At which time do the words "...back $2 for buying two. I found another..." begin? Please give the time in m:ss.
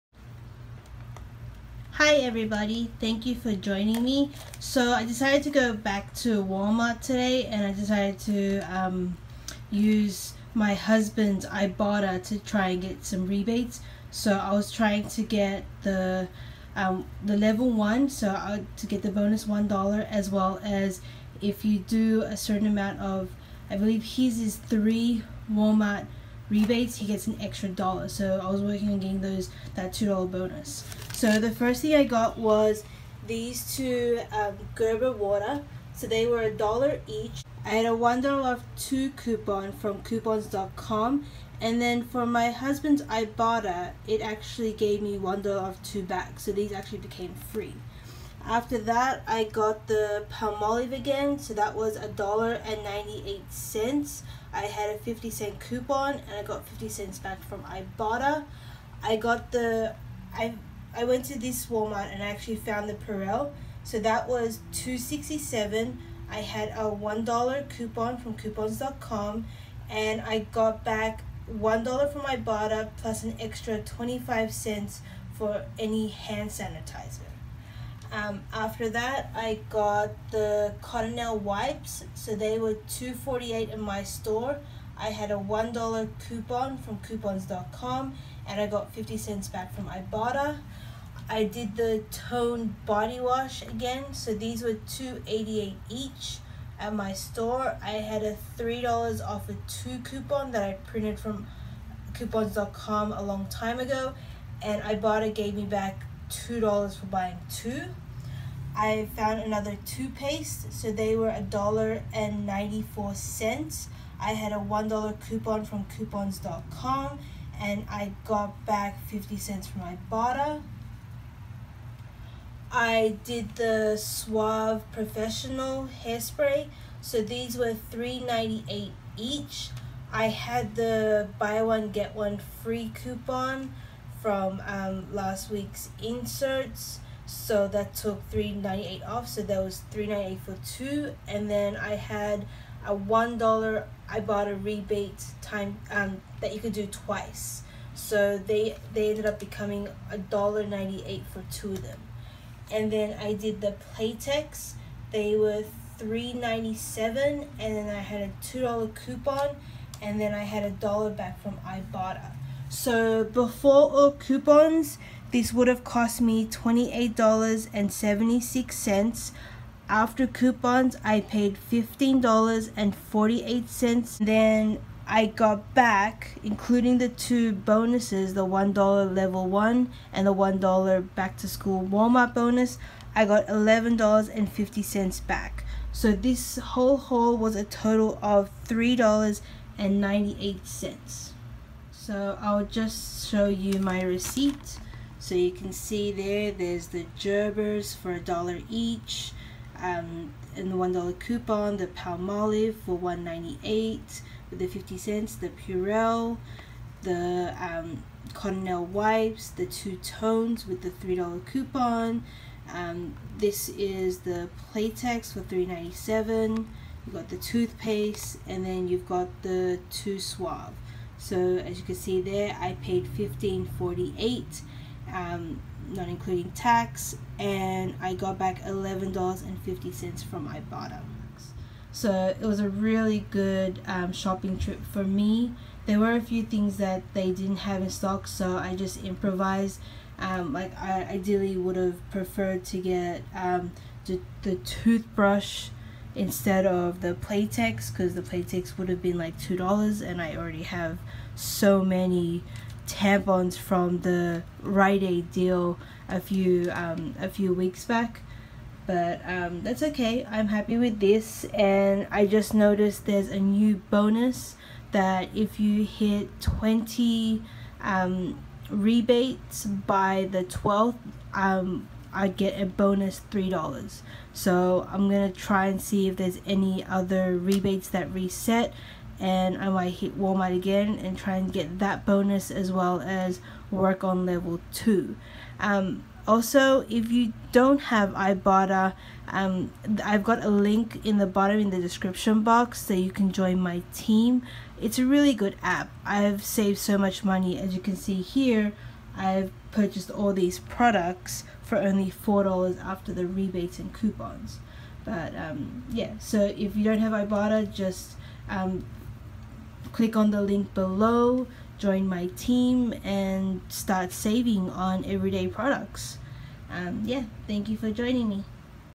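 1:45.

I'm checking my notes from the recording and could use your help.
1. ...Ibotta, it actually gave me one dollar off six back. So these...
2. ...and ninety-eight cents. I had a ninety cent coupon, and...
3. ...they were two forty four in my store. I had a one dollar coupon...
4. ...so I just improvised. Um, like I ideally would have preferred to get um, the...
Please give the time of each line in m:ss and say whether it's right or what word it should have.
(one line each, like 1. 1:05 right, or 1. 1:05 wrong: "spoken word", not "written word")
1. 0:43 wrong: "two", not "six"
2. 0:52 wrong: "fifty", not "ninety"
3. 1:22 wrong: "eight", not "four"
4. 3:58 right.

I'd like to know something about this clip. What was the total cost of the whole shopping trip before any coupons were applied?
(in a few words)
$28.76.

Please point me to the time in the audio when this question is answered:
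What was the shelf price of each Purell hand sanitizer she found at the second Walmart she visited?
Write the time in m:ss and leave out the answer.
1:04.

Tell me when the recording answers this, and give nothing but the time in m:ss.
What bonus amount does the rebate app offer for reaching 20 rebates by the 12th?
4:32.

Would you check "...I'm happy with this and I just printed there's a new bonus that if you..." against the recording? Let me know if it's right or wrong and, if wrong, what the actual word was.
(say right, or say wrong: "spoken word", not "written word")
wrong: "noticed", not "printed".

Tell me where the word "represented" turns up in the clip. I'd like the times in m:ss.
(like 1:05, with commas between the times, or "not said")
not said.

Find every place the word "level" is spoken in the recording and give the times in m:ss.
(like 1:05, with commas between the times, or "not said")
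0:17, 2:59, 4:44.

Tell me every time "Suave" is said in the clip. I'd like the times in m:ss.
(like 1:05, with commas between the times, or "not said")
2:03, 3:40.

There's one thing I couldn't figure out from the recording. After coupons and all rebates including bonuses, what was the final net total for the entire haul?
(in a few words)
$3.98.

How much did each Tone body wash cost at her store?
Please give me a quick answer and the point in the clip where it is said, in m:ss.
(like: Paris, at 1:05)
$2.88, at 1:34.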